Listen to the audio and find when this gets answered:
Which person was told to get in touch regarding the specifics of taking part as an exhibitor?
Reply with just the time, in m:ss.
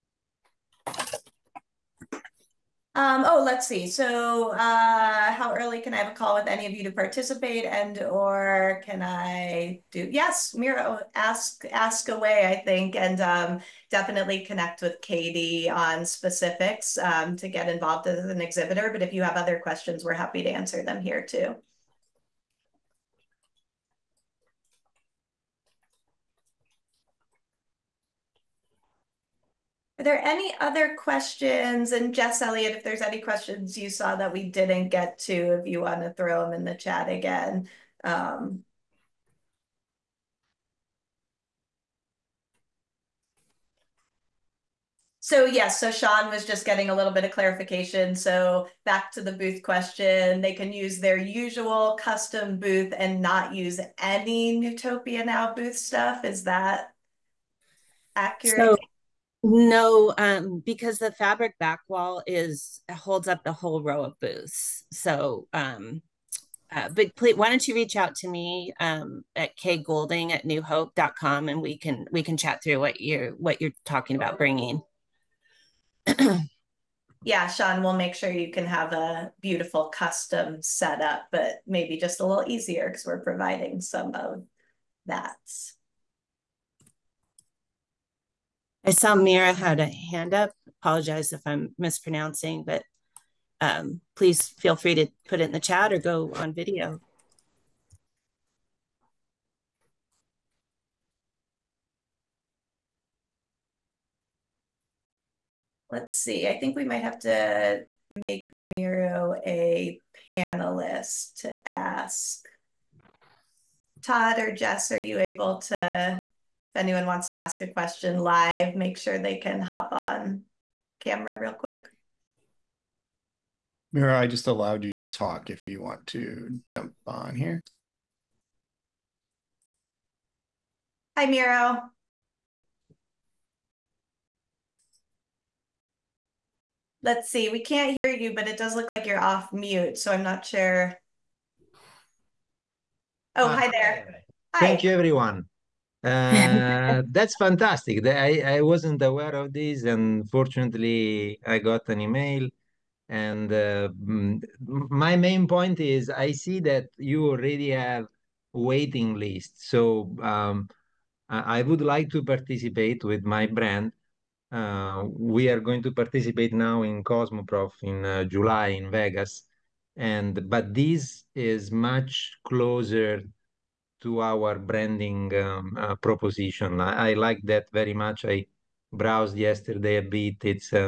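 0:15.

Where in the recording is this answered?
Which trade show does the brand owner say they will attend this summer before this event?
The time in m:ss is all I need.
2:47.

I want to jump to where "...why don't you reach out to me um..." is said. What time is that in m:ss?
1:07.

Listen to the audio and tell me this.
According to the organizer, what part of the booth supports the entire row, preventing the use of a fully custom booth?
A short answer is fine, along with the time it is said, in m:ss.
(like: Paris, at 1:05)
fabric back wall, at 1:01.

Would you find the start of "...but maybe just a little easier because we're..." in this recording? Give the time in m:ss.
1:21.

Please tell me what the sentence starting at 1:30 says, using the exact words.
Apologize if I'm mispronouncing, but um, please feel free to put it in the chat or go on video.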